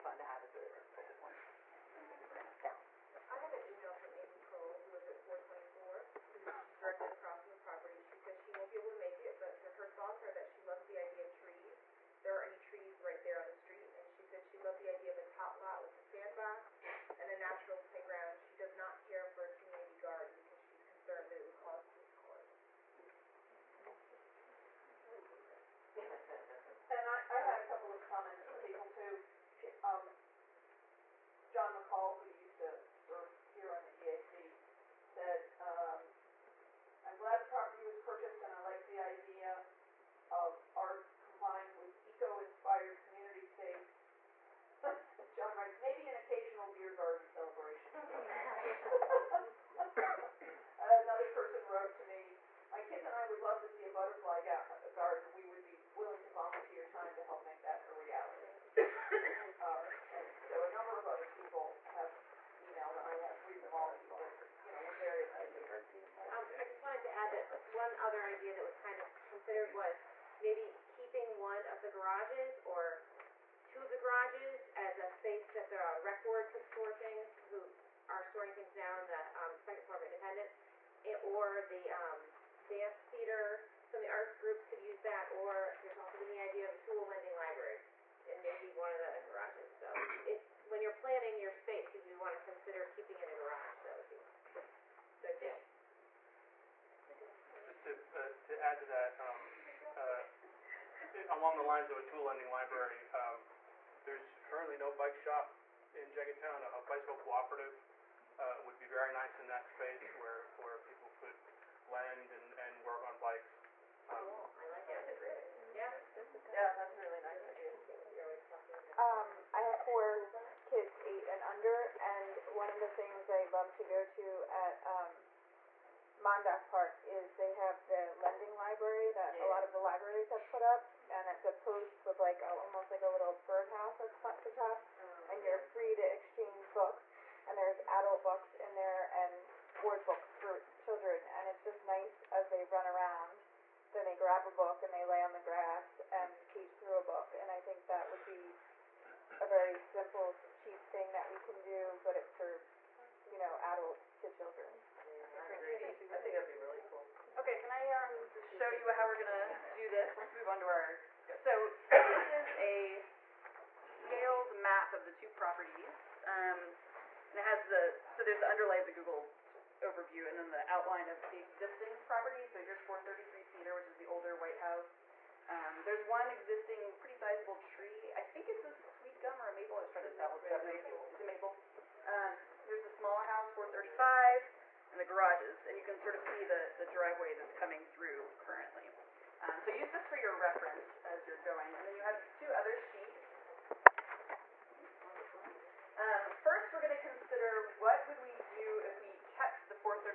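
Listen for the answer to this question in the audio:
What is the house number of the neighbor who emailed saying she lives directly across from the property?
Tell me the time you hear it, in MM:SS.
00:05.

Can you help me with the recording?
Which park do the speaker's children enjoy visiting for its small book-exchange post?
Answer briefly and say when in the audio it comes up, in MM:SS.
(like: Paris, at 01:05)
Mondauk Park, at 02:06.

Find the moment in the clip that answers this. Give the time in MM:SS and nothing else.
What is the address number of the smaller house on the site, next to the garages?
03:03.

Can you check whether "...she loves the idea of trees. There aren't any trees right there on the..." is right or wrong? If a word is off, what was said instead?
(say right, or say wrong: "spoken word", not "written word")
right.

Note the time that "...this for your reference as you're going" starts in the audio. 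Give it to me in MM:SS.
03:09.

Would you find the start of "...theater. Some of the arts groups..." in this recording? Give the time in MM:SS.
01:23.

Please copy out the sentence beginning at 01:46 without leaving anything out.
A, a bicycle cooperative uh, would be very nice in that space where, where people could lend and, and work on bikes.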